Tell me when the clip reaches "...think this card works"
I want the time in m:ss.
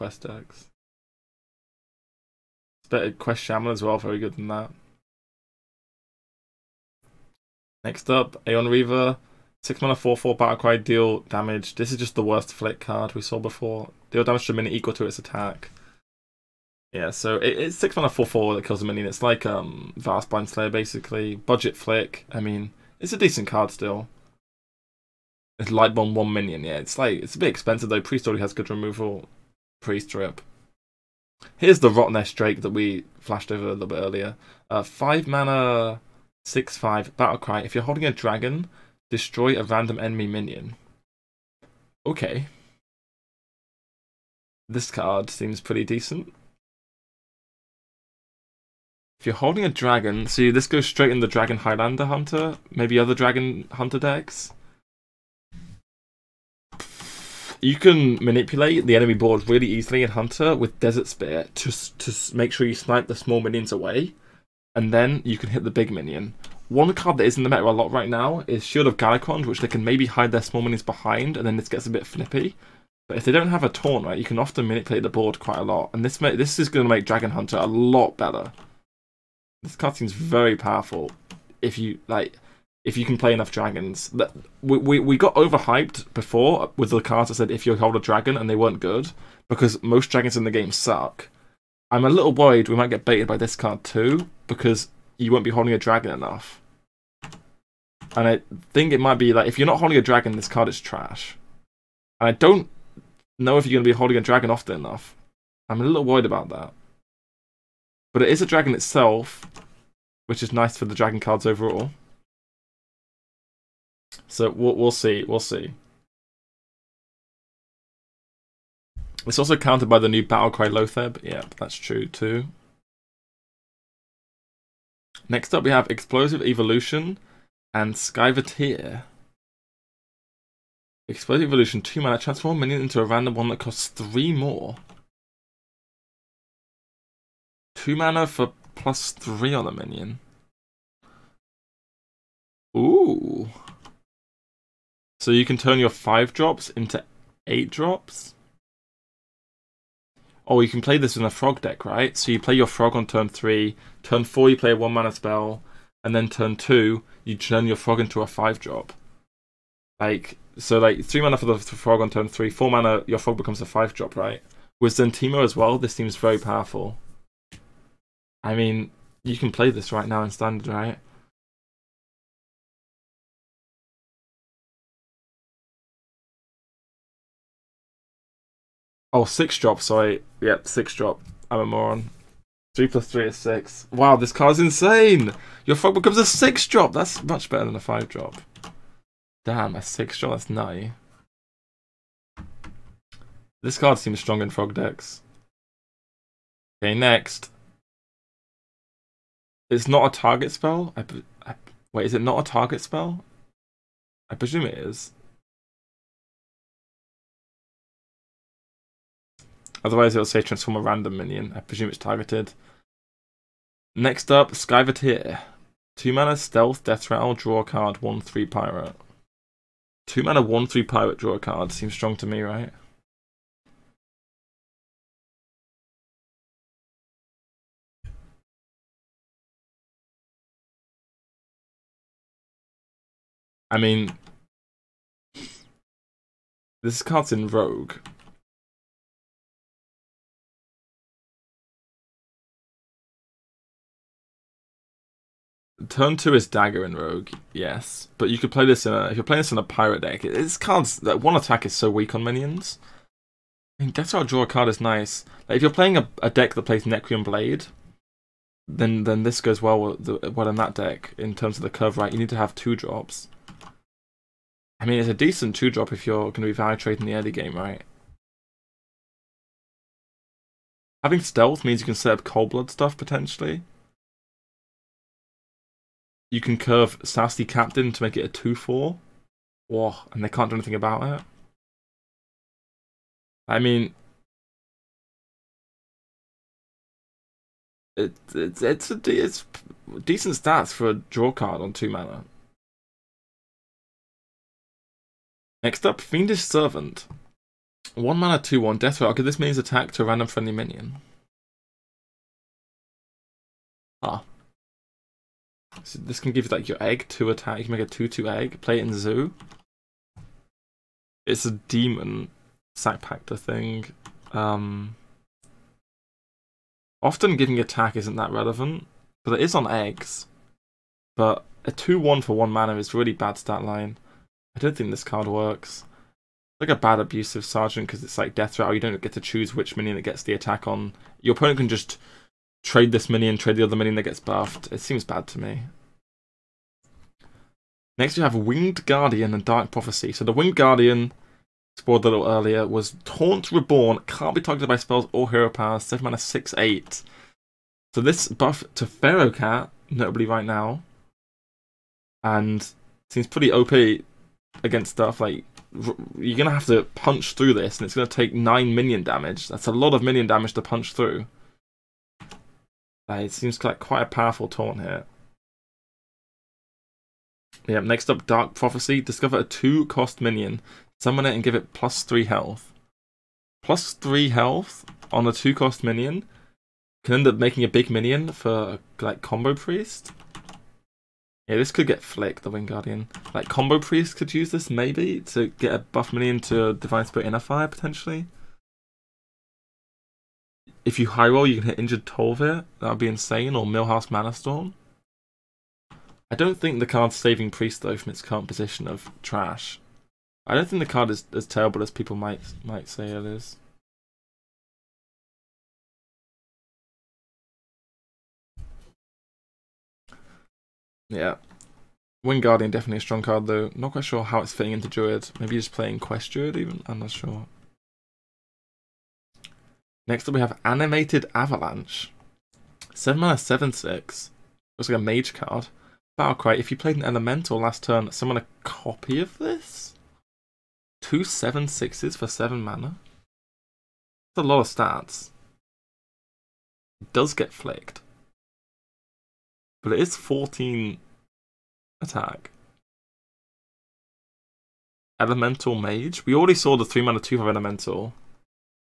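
5:24.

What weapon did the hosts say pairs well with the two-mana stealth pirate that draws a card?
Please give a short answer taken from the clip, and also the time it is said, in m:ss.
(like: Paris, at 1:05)
Necrium Blade, at 4:16.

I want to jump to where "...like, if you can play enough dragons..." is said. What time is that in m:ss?
1:22.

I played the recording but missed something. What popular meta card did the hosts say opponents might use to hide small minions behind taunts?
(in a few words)
Shield of Galakrond.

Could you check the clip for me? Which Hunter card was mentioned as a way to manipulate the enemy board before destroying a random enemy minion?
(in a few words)
Desert Spear.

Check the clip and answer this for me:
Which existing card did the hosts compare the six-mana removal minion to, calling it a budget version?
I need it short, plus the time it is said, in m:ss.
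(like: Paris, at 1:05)
Vast Blind Slayer, at 0:19.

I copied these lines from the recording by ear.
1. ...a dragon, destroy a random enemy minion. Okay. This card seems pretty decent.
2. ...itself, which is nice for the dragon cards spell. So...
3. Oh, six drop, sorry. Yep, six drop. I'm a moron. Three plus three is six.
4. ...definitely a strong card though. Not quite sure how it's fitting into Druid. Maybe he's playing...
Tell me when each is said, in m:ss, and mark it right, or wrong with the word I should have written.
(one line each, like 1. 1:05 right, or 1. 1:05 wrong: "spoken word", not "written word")
1. 0:38 right
2. 1:48 wrong: "overall", not "spell"
3. 2:59 right
4. 6:52 right.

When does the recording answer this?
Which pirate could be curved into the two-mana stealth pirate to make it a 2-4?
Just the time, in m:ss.
4:37.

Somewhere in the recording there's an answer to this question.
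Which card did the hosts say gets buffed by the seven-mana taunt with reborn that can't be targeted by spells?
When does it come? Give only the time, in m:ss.
5:48.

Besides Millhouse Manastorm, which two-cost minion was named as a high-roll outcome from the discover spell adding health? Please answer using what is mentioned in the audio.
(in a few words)
Injured Tol'vir.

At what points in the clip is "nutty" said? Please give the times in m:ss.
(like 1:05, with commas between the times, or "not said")
3:10.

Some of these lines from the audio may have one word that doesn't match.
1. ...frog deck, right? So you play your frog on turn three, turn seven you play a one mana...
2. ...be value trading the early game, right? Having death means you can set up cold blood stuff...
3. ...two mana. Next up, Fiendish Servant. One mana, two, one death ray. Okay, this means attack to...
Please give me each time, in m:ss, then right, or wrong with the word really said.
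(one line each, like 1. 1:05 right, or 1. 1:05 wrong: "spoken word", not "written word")
1. 2:31 wrong: "four", not "seven"
2. 4:26 wrong: "stealth", not "death"
3. 4:51 right.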